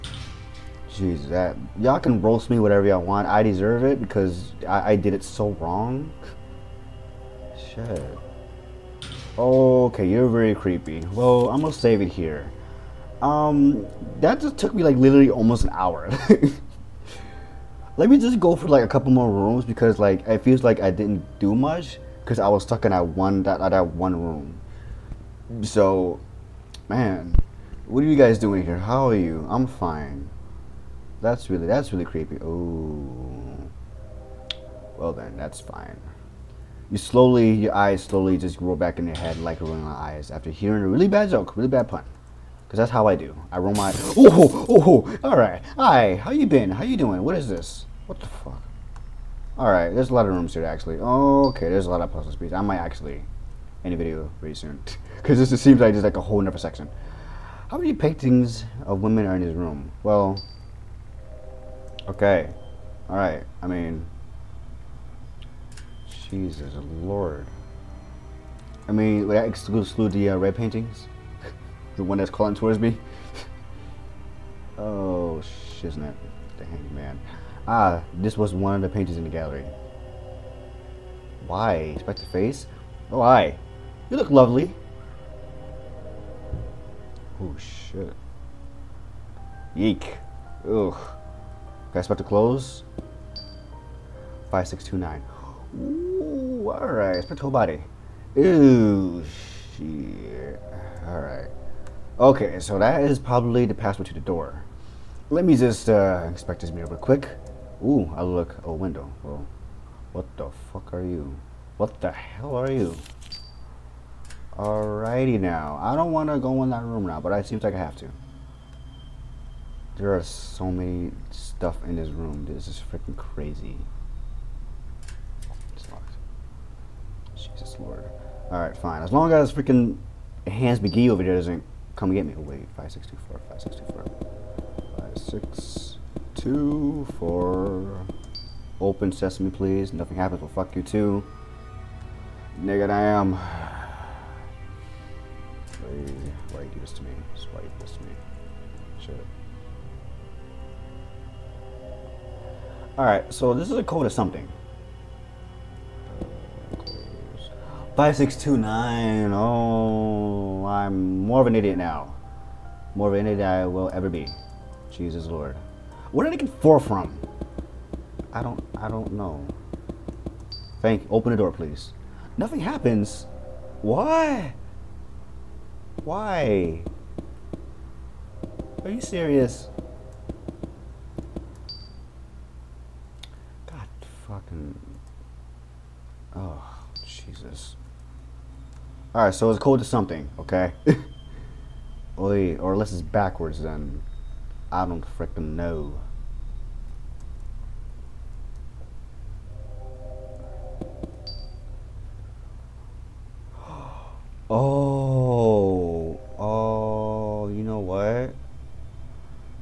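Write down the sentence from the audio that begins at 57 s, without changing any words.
How many paintings of women are in his room?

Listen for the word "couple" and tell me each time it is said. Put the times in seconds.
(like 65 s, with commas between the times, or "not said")
18 s.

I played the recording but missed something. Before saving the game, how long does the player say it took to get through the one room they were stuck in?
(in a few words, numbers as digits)
Almost an hour.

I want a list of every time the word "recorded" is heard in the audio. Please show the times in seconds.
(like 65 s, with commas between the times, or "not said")
not said.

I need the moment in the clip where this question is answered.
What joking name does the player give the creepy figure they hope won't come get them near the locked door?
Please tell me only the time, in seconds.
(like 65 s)
130 s.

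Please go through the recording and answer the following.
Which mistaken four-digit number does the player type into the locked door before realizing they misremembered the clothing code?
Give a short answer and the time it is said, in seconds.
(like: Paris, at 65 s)
5624, at 135 s.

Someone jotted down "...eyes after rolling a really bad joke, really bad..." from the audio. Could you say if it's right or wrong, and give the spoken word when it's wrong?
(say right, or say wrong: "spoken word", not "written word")
wrong: "hearing", not "rolling".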